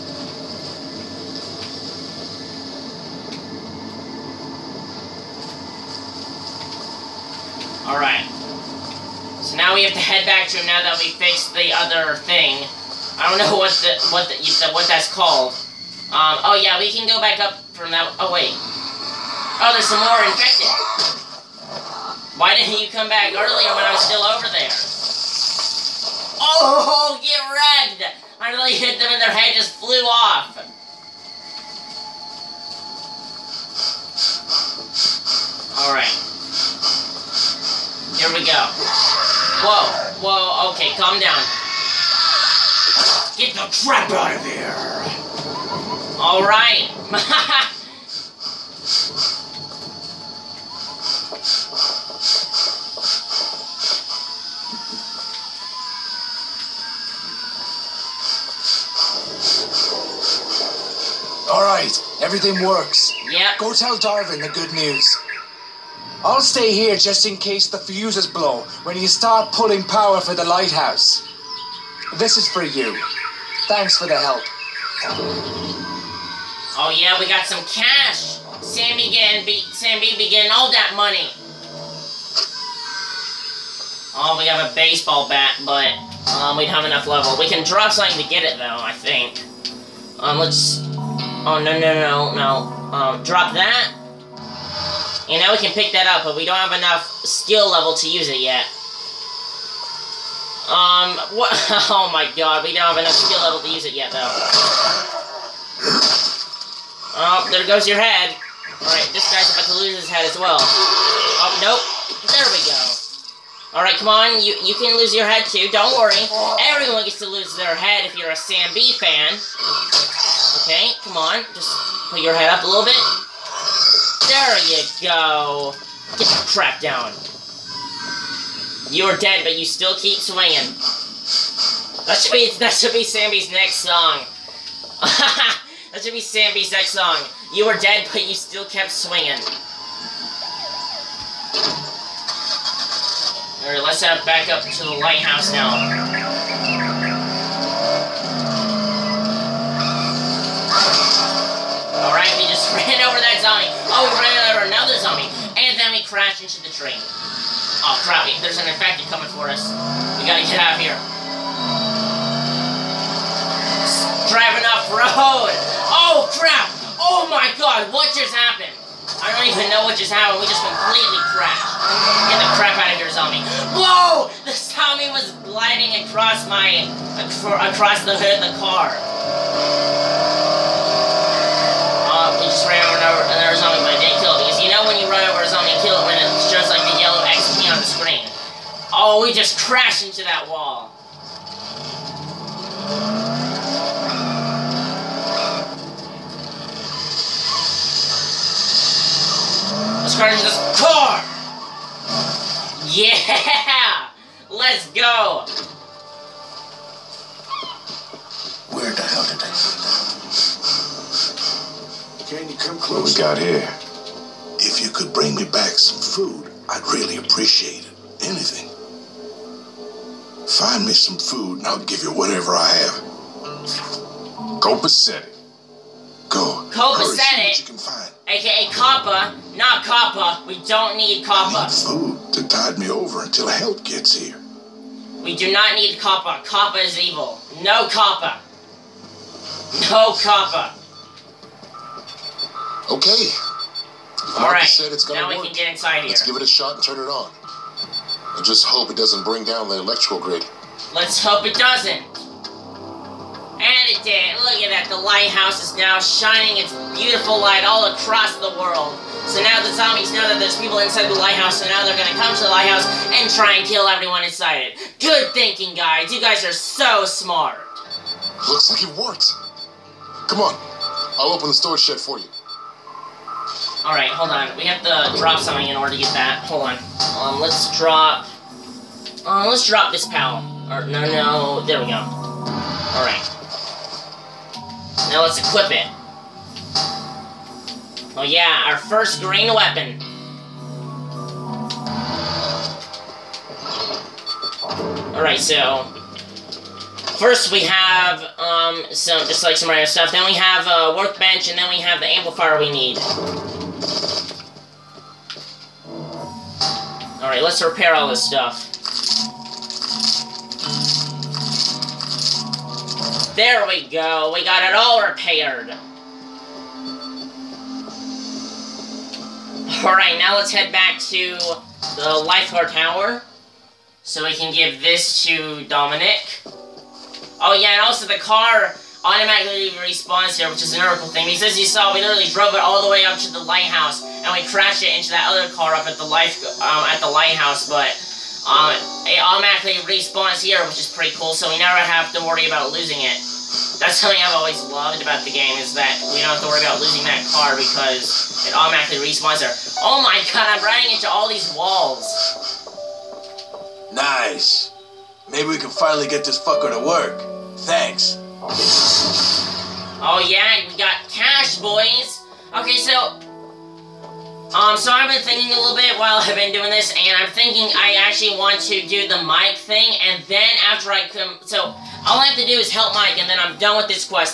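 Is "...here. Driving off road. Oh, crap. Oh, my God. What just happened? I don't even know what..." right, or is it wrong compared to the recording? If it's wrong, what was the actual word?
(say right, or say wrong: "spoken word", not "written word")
right.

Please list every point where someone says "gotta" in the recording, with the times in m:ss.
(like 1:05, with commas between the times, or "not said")
2:40.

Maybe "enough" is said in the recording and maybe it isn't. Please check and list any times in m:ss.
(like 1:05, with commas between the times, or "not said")
1:26, 1:36, 1:43.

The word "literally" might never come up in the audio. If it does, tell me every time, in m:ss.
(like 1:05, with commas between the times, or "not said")
5:32.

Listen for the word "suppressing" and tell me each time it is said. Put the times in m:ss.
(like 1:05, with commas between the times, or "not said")
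not said.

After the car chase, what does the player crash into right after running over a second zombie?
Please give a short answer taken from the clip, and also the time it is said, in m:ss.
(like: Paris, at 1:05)
the train, at 2:36.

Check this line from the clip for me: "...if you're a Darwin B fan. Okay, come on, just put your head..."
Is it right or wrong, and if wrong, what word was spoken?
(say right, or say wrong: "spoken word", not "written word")
wrong: "Sam", not "Darwin".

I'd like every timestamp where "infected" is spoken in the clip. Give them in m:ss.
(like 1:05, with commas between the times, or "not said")
0:20, 2:38.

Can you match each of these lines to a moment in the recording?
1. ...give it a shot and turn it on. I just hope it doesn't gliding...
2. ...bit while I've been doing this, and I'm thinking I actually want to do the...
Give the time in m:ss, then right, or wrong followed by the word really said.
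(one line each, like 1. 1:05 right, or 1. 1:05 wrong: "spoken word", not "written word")
1. 4:06 wrong: "bring", not "gliding"
2. 6:05 right.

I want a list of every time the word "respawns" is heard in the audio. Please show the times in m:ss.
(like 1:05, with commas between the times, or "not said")
5:29, 5:39, 5:49.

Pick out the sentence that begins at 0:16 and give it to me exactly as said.
Um, oh yeah, we can go back up from that.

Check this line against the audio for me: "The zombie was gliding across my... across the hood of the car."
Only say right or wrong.
right.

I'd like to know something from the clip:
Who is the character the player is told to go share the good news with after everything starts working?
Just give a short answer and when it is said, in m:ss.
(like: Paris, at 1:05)
Darwin, at 1:03.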